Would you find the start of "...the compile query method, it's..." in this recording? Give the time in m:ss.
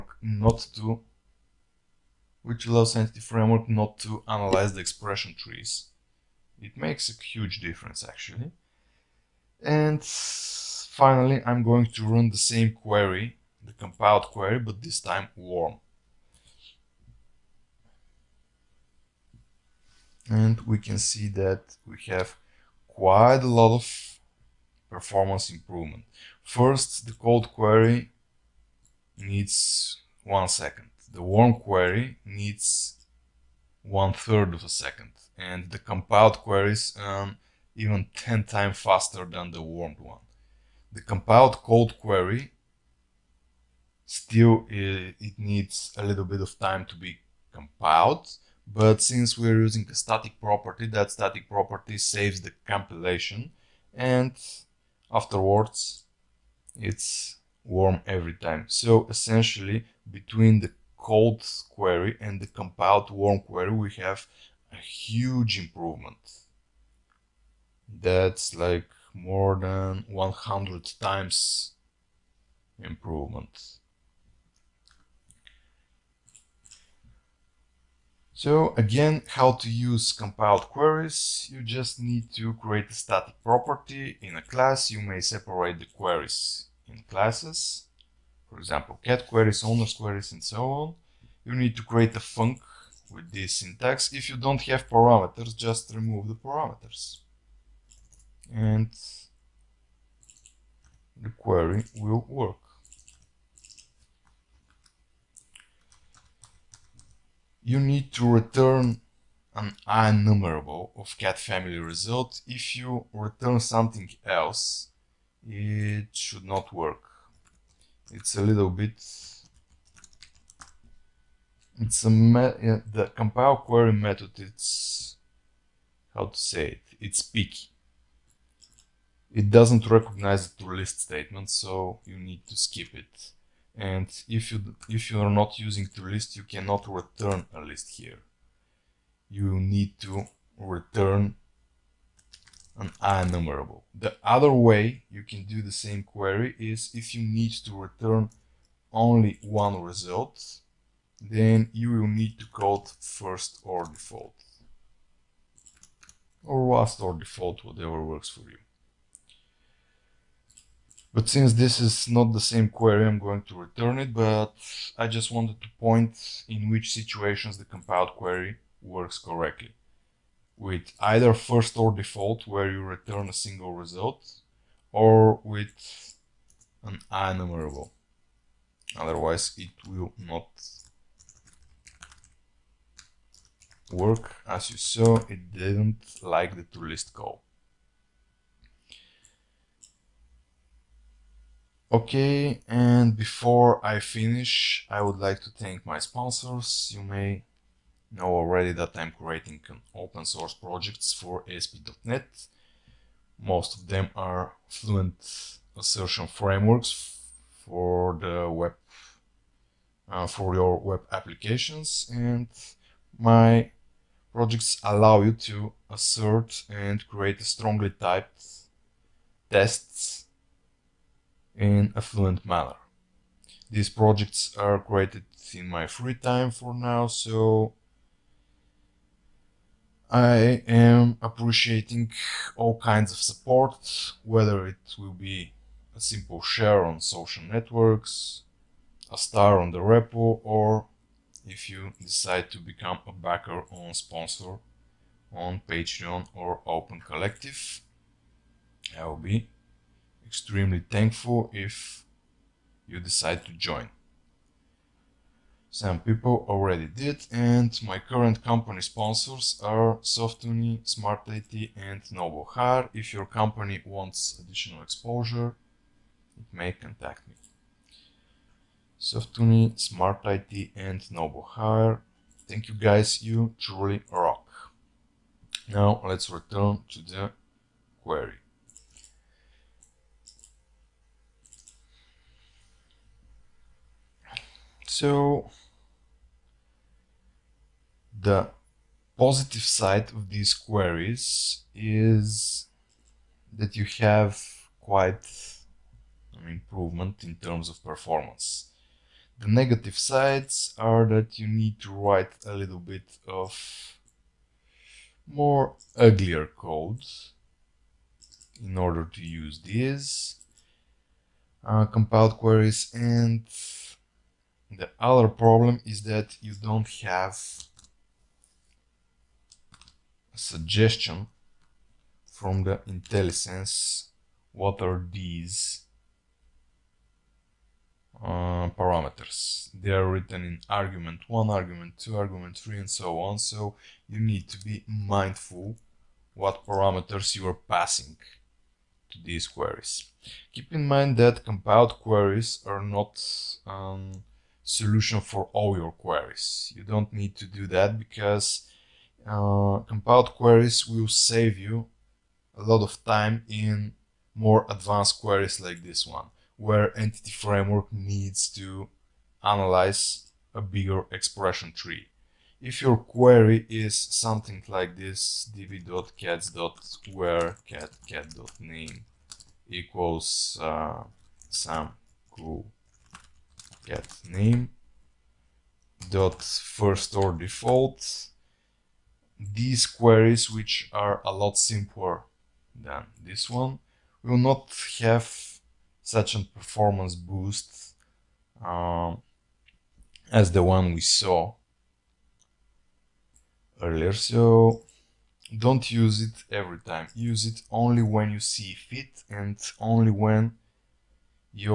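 2:02.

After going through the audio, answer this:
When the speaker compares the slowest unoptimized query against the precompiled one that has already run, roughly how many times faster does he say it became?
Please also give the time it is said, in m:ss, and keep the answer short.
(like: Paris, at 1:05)
more than 100 times, at 1:09.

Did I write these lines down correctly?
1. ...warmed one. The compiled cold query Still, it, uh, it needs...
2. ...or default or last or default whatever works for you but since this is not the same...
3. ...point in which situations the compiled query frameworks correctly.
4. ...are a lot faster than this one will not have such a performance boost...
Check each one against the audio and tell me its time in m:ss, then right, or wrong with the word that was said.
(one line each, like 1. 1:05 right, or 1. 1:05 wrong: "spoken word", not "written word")
1. 0:39 right
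2. 2:33 right
3. 2:45 wrong: "works", not "frameworks"
4. 6:20 wrong: "simpler", not "faster".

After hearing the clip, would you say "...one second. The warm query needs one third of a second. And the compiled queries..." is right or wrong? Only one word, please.
right.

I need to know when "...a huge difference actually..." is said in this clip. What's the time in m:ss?
0:07.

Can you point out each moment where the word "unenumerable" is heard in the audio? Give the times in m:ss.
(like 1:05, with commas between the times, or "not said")
2:23.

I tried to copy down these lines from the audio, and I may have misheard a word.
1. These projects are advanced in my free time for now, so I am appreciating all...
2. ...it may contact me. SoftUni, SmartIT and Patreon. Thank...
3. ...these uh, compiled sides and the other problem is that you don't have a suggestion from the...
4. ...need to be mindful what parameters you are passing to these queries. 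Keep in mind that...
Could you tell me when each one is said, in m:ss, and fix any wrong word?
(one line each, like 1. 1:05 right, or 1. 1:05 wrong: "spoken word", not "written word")
1. 3:43 wrong: "created", not "advanced"
2. 4:26 wrong: "Novohar", not "Patreon"
3. 5:09 wrong: "queries", not "sides"
4. 5:34 right.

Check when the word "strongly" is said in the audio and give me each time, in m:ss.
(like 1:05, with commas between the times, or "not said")
3:37.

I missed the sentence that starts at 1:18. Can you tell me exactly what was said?
So again, how to use compiled queries.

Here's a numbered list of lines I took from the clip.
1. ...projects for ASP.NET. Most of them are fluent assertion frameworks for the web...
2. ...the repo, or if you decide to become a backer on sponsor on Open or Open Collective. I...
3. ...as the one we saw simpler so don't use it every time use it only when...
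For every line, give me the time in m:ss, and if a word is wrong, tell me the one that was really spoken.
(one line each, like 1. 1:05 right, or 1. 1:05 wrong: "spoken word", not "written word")
1. 3:20 right
2. 3:59 wrong: "Patreon", not "Open"
3. 6:30 wrong: "earlier", not "simpler".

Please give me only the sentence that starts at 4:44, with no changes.
So the positive side of these queries is that you have quite an improvement in terms of performance.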